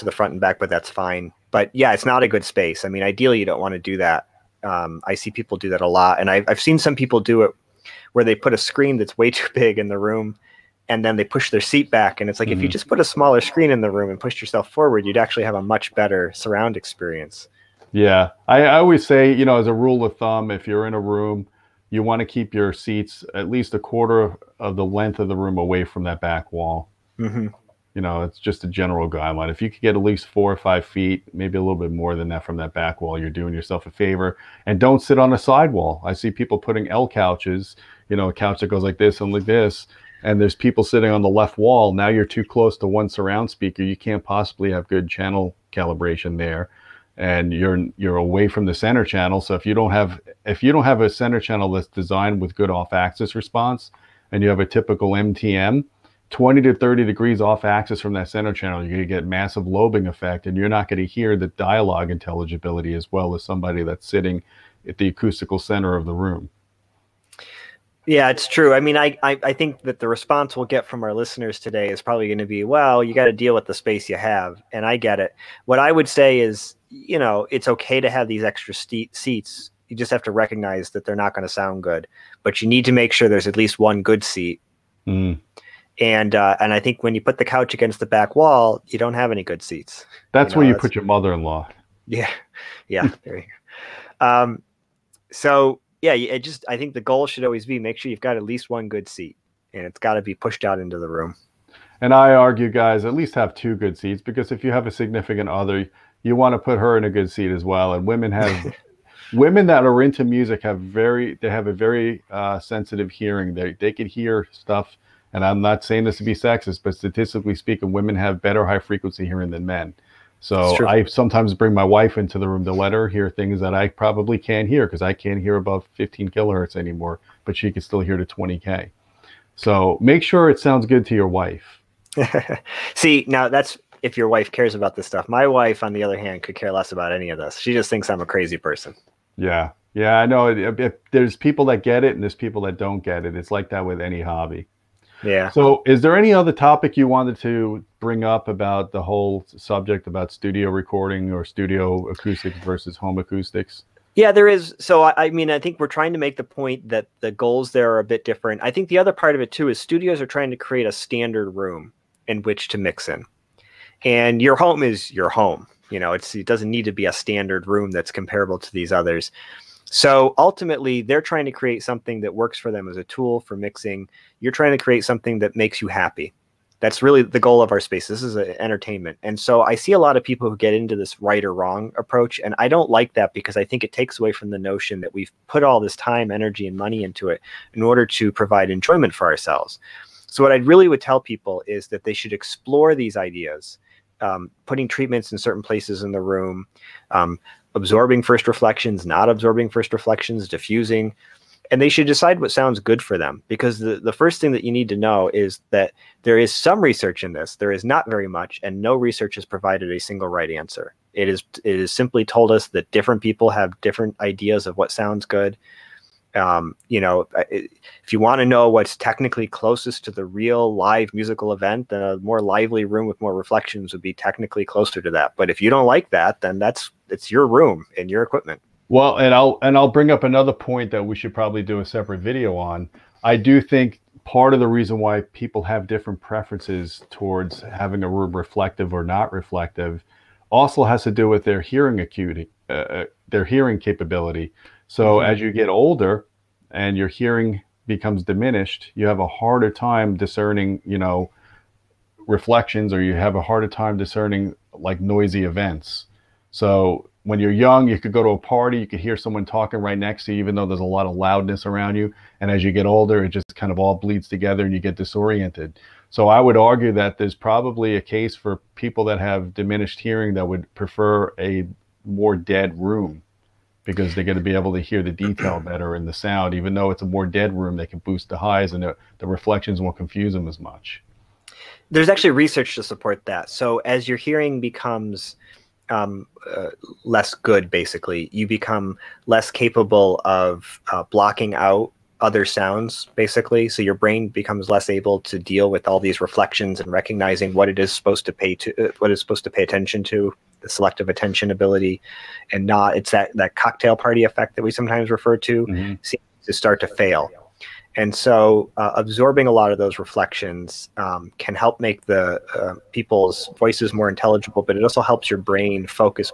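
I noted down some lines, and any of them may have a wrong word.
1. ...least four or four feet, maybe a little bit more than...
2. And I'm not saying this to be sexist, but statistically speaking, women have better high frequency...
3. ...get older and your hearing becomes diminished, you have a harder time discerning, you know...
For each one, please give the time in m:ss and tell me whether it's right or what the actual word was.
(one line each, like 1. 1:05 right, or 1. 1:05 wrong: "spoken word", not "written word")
1. 0:30 wrong: "five", not "four"
2. 1:55 right
3. 4:05 right.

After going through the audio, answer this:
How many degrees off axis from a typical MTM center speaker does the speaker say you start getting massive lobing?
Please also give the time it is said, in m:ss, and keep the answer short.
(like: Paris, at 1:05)
20 to 30 degrees, at 0:56.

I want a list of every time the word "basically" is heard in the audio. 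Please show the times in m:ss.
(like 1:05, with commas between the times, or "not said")
4:47, 4:53.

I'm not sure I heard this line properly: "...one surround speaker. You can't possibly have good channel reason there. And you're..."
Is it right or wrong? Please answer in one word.
wrong.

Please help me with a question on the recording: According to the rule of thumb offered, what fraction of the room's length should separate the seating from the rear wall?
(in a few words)
a quarter.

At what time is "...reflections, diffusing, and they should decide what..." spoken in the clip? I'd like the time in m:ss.
3:19.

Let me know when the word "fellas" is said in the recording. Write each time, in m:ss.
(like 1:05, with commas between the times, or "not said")
not said.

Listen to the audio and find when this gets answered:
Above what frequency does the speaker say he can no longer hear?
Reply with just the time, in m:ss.
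2:05.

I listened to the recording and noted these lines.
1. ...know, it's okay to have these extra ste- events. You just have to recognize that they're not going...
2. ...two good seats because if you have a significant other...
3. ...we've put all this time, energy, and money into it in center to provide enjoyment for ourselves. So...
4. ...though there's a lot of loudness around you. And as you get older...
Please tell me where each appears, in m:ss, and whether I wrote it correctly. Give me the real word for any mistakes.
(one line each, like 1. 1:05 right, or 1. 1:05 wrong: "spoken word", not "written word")
1. 1:17 wrong: "seats", not "events"
2. 1:43 right
3. 3:05 wrong: "order", not "center"
4. 4:20 right.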